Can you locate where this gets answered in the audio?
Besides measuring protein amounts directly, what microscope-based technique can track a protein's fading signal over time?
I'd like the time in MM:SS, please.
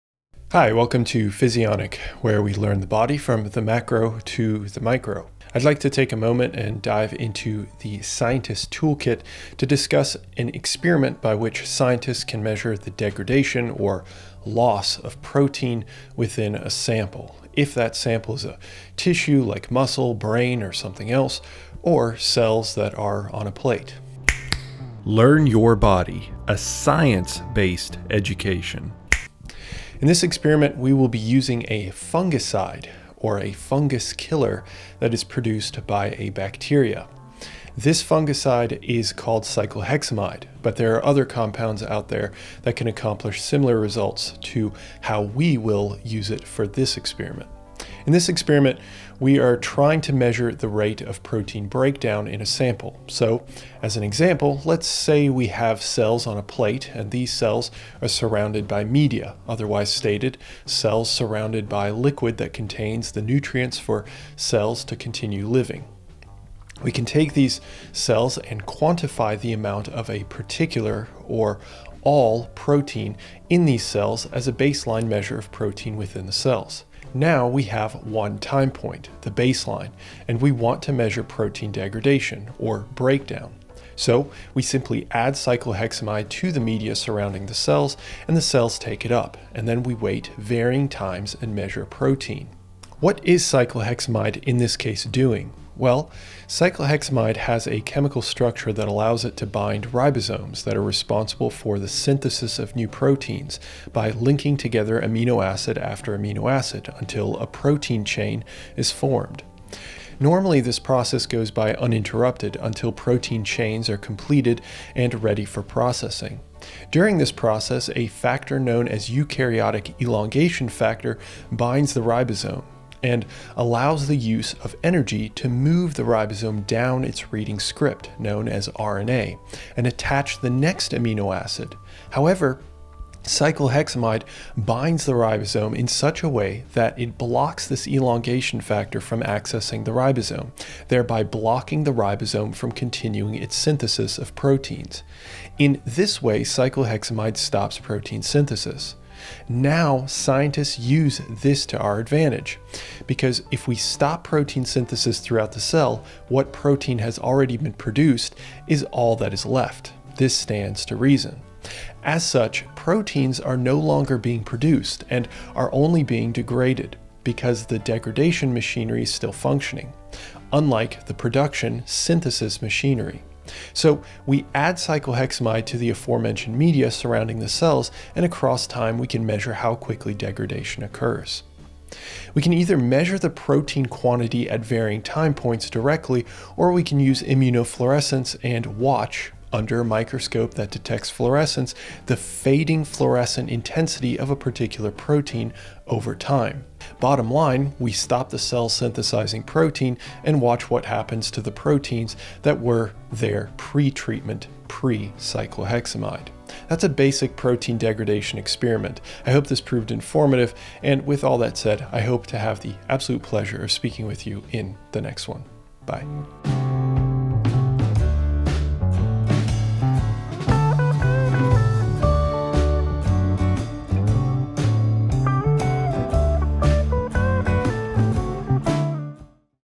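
03:07.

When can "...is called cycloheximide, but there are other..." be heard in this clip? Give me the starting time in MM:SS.
00:38.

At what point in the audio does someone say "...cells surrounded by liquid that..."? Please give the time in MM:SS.
01:00.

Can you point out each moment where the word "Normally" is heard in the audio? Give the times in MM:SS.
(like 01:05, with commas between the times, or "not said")
01:50.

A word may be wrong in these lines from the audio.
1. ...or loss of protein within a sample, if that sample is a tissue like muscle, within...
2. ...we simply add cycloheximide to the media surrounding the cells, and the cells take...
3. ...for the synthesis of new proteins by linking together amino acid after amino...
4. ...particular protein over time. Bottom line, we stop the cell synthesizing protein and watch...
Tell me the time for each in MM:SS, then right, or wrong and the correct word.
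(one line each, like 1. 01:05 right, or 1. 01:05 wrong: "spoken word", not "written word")
1. 00:13 wrong: "brain", not "within"
2. 01:24 right
3. 01:41 right
4. 03:14 right.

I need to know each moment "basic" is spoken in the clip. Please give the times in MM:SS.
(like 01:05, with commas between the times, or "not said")
03:26.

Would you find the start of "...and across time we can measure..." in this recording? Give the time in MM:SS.
02:58.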